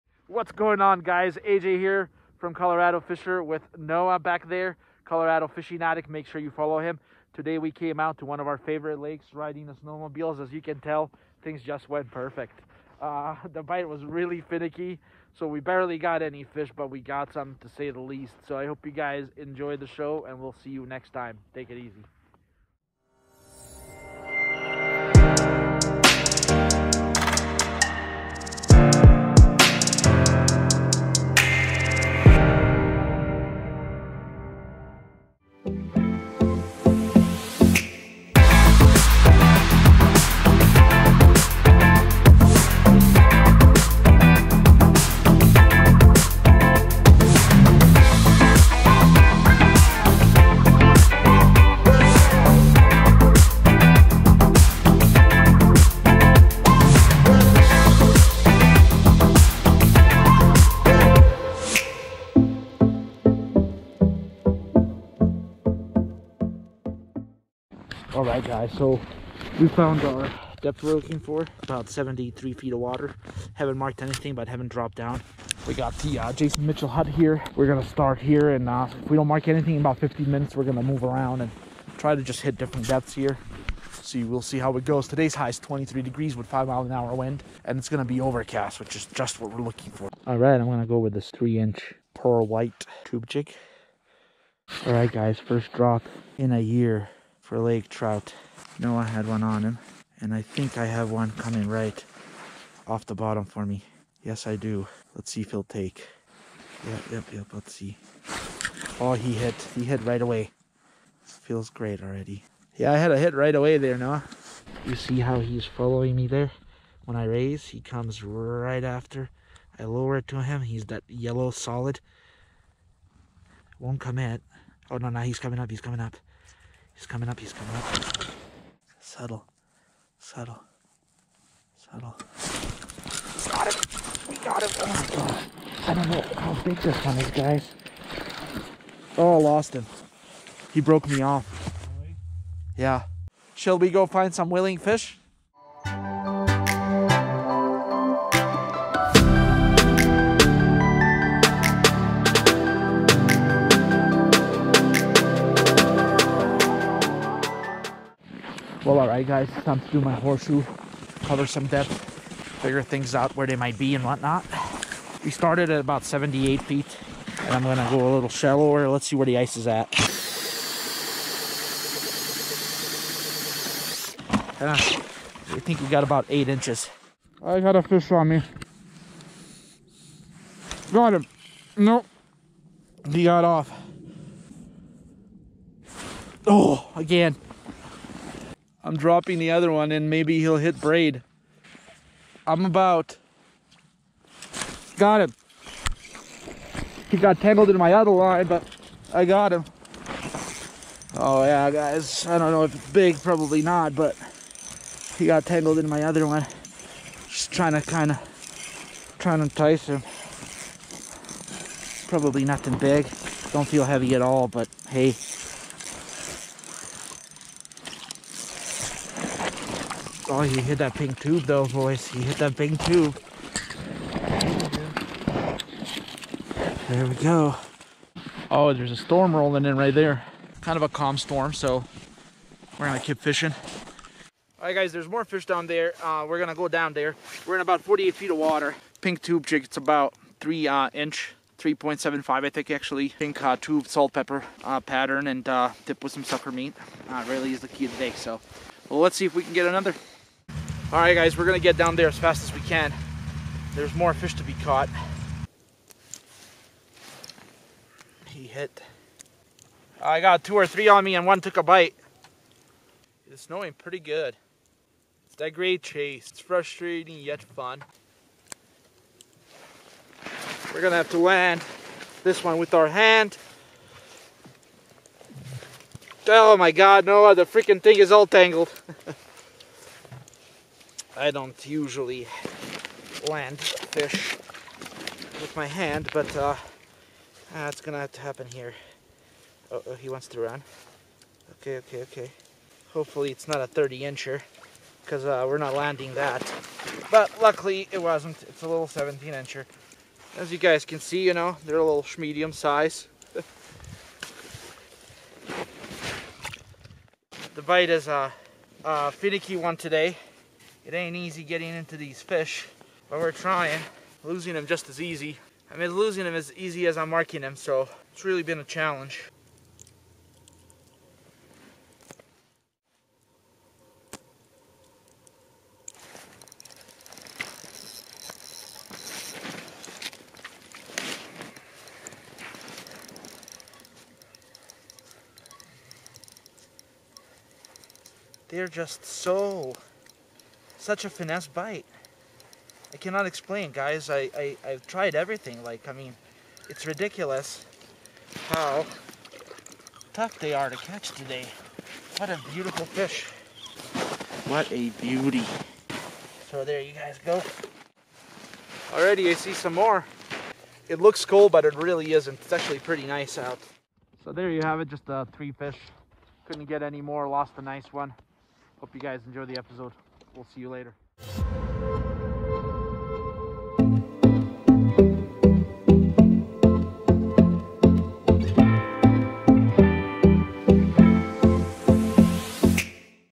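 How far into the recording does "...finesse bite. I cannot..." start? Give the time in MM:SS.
05:41.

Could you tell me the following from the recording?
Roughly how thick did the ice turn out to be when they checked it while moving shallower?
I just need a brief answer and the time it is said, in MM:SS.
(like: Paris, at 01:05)
8 inches, at 02:56.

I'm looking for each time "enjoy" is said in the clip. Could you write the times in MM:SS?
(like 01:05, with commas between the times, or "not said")
00:19, 06:09.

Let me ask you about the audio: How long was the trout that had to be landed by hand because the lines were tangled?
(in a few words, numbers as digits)
17 inches.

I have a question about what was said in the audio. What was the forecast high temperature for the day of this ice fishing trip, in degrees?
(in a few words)
23.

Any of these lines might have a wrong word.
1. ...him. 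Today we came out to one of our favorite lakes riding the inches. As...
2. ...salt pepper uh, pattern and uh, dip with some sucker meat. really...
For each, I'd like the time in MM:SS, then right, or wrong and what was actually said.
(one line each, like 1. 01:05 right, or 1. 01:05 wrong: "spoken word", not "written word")
1. 00:06 wrong: "snowmobiles", not "inches"
2. 04:03 right.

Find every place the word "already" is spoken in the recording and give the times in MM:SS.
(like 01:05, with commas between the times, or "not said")
01:52, 05:58.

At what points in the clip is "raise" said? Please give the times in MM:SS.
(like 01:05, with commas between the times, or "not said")
01:57.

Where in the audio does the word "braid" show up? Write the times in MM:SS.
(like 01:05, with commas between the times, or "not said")
03:10.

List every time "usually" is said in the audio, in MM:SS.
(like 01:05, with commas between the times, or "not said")
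04:41.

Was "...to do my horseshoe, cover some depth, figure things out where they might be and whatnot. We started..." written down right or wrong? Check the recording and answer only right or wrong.
right.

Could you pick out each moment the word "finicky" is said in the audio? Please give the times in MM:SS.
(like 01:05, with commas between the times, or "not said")
00:14, 05:09.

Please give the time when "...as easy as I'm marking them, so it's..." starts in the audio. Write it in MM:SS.
05:16.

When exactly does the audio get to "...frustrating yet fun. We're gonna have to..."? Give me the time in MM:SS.
04:26.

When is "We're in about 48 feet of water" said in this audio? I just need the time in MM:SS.
03:57.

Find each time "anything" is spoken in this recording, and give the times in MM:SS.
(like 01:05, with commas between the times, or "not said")
01:14, 01:19.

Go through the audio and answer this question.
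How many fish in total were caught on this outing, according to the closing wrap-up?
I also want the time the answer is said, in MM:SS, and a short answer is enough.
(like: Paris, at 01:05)
3, at 06:05.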